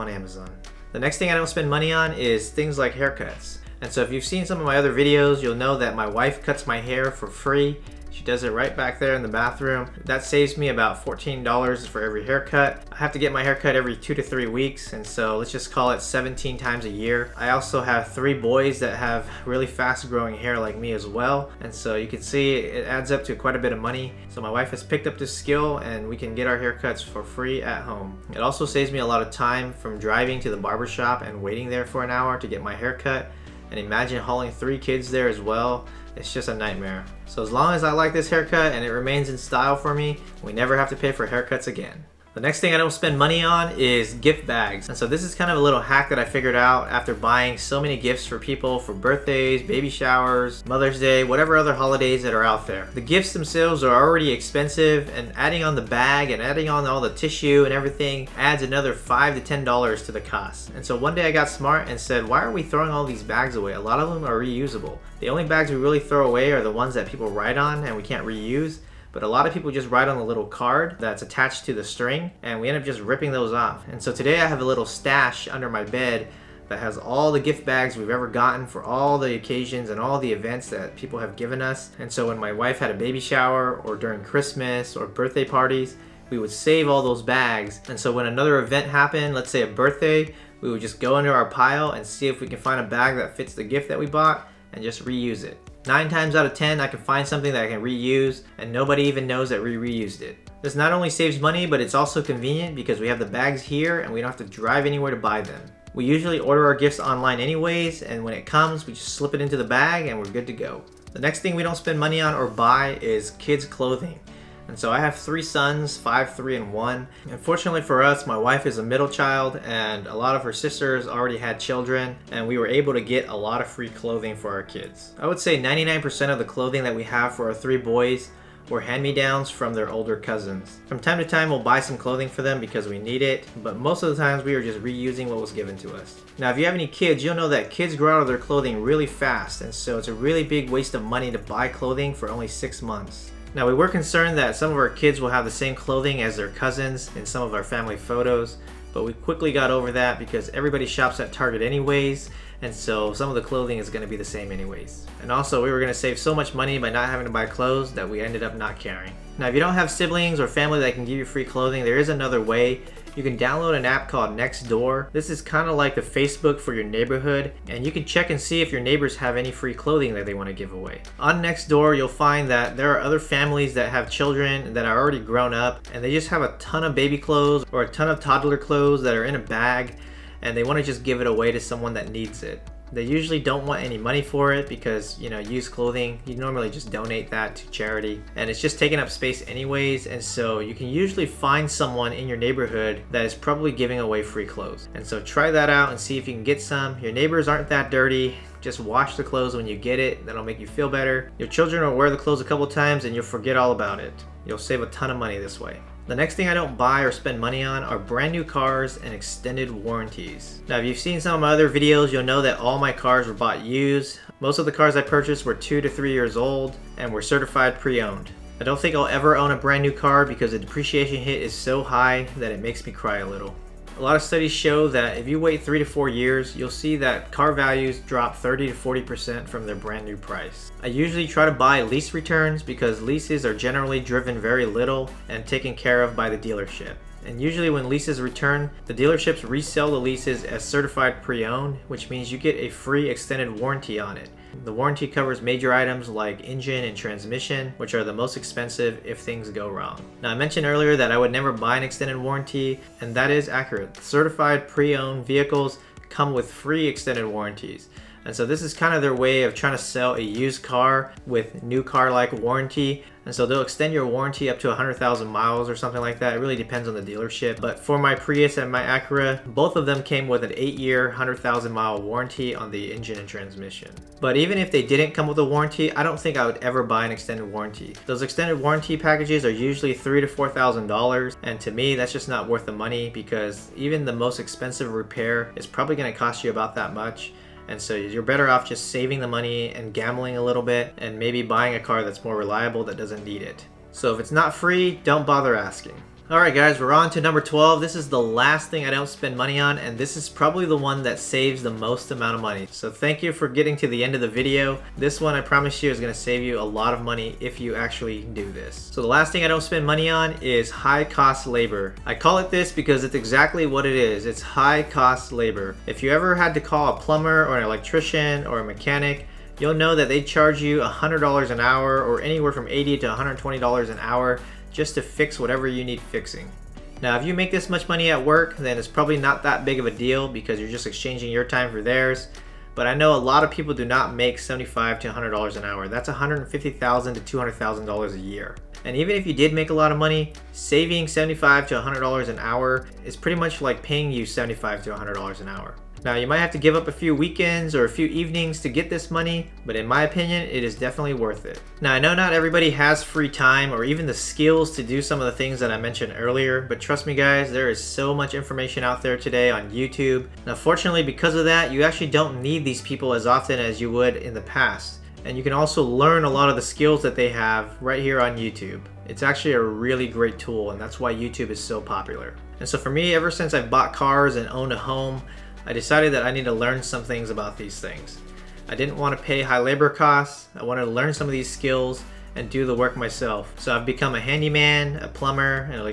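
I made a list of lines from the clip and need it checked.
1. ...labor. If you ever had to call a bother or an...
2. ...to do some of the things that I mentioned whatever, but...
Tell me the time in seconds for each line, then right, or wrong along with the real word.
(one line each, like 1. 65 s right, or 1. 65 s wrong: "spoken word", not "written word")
1. 315 s wrong: "plumber", not "bother"
2. 354 s wrong: "earlier", not "whatever".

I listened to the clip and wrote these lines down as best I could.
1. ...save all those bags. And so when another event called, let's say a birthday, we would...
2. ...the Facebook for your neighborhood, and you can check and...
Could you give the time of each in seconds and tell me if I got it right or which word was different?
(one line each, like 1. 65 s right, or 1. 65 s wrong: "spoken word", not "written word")
1. 86 s wrong: "happened", not "called"
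2. 165 s right.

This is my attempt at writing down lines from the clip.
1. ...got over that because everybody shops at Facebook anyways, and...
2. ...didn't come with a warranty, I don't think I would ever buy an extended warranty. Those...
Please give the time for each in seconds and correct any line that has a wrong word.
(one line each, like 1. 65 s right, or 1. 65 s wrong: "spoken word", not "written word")
1. 149 s wrong: "Target", not "Facebook"
2. 274 s right.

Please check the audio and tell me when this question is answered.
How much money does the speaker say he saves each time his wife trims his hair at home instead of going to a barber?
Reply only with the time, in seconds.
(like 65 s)
11 s.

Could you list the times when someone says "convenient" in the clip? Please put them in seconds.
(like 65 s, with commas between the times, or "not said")
102 s.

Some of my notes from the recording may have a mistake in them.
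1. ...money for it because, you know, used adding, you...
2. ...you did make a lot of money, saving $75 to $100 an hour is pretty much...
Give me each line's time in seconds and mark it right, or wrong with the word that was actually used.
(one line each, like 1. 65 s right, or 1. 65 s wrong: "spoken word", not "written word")
1. 183 s wrong: "clothing", not "adding"
2. 339 s right.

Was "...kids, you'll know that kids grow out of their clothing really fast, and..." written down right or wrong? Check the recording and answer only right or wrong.
right.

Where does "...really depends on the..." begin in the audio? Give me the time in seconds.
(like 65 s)
266 s.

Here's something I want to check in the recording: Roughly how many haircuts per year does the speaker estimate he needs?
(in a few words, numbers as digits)
17.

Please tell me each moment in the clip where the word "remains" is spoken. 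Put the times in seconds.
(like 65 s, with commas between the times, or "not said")
38 s.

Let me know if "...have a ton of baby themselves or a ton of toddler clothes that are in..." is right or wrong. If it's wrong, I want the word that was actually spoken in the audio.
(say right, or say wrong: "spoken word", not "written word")
wrong: "clothes", not "themselves".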